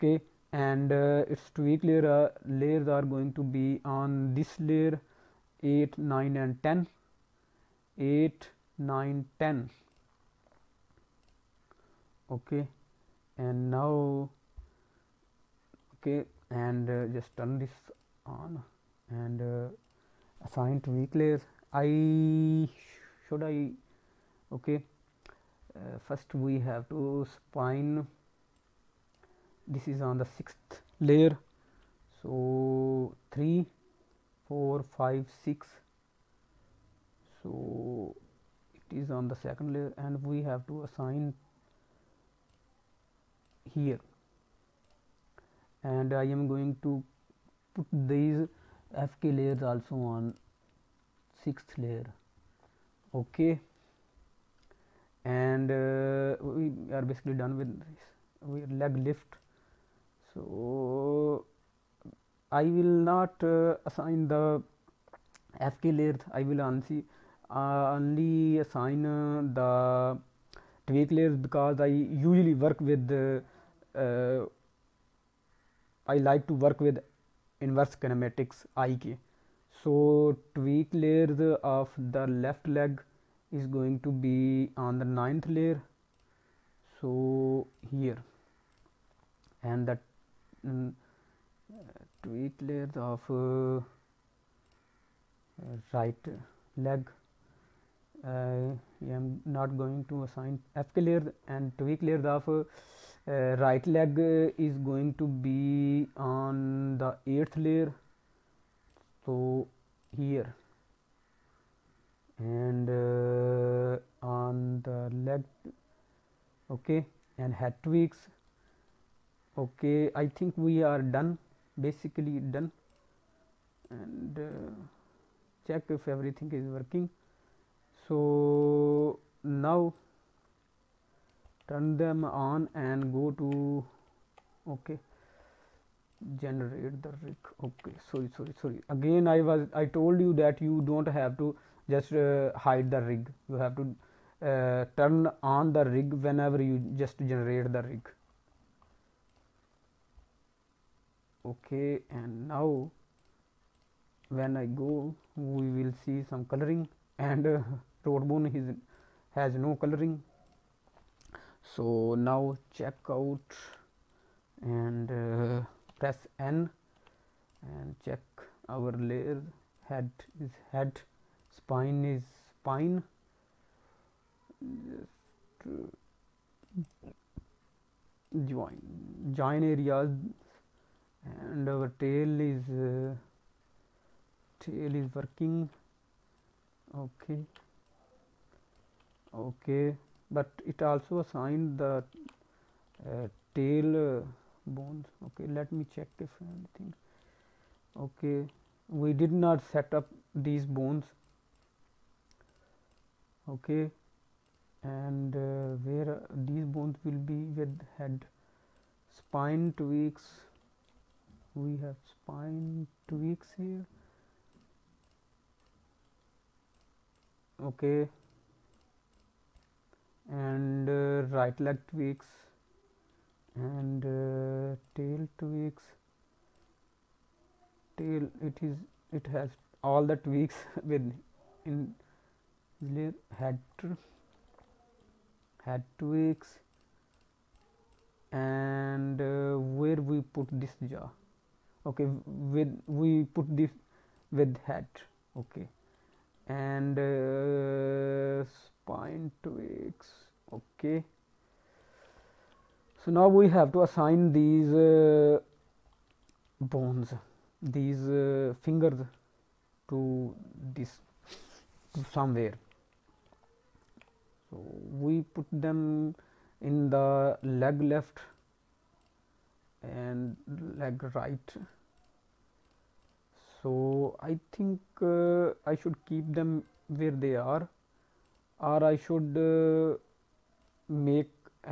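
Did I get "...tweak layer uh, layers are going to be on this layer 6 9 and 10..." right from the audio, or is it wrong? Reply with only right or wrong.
wrong.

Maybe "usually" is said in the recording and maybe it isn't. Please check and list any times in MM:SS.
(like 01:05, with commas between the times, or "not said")
01:11.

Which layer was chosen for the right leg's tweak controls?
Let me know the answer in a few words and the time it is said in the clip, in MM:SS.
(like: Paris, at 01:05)
8th, at 01:47.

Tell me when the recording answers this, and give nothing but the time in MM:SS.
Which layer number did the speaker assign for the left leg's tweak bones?
01:25.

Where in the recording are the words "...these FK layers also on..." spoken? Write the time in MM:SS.
00:48.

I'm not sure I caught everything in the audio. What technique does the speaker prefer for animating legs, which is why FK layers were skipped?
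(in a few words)
Inverse kinematics (IK).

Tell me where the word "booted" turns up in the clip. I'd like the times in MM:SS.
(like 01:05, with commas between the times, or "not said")
not said.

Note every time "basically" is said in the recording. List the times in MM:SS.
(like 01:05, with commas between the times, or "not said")
00:57, 02:01.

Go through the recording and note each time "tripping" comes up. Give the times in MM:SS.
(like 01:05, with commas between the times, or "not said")
not said.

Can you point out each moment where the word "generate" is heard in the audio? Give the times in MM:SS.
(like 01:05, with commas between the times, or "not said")
02:16, 02:27.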